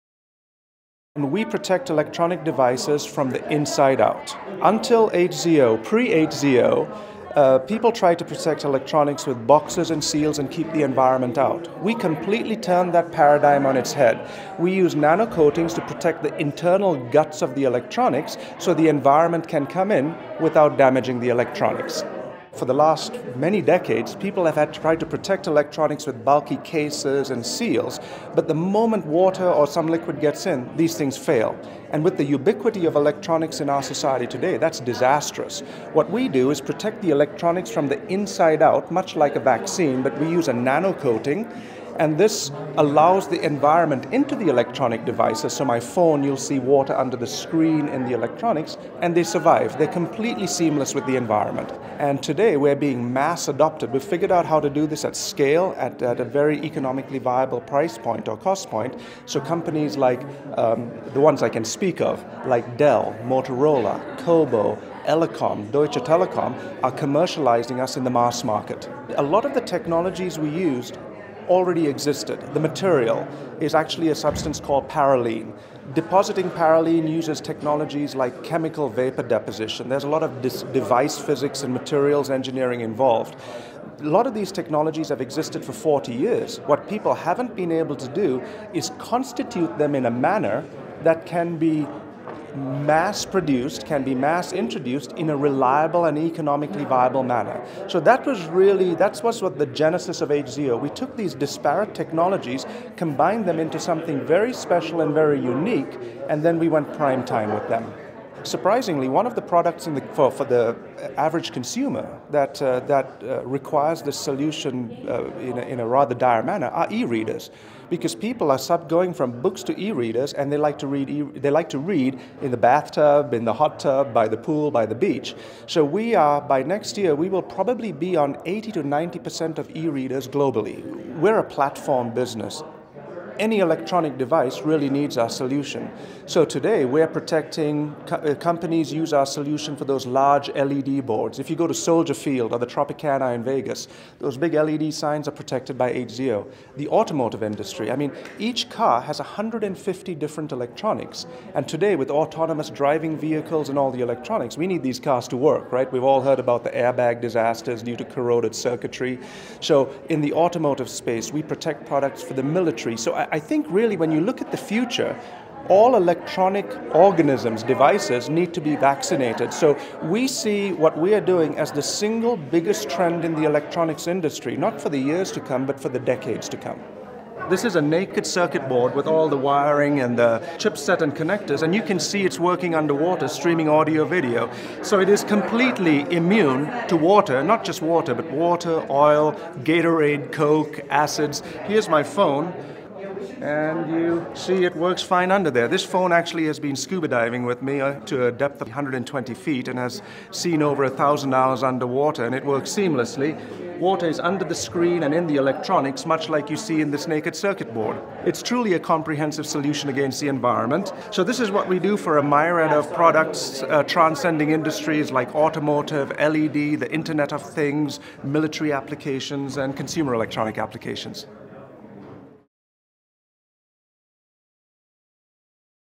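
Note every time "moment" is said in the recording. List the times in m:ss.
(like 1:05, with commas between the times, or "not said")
0:28.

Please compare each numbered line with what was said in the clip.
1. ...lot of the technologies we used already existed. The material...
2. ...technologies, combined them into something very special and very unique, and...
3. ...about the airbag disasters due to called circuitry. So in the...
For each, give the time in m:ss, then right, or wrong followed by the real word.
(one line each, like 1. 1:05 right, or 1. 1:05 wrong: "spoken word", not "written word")
1. 1:09 right
2. 1:41 right
3. 2:36 wrong: "corroded", not "called".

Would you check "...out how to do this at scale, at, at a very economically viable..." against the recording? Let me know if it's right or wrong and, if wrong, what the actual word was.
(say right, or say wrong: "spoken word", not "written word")
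right.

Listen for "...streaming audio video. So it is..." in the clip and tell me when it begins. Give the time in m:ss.
3:03.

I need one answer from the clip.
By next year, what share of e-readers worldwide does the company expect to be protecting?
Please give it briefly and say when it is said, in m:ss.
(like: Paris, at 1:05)
80 to 90 percent, at 2:08.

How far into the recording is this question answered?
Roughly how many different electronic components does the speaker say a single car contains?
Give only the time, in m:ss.
2:29.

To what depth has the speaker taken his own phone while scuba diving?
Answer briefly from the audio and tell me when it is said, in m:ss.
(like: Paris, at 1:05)
120 feet, at 3:18.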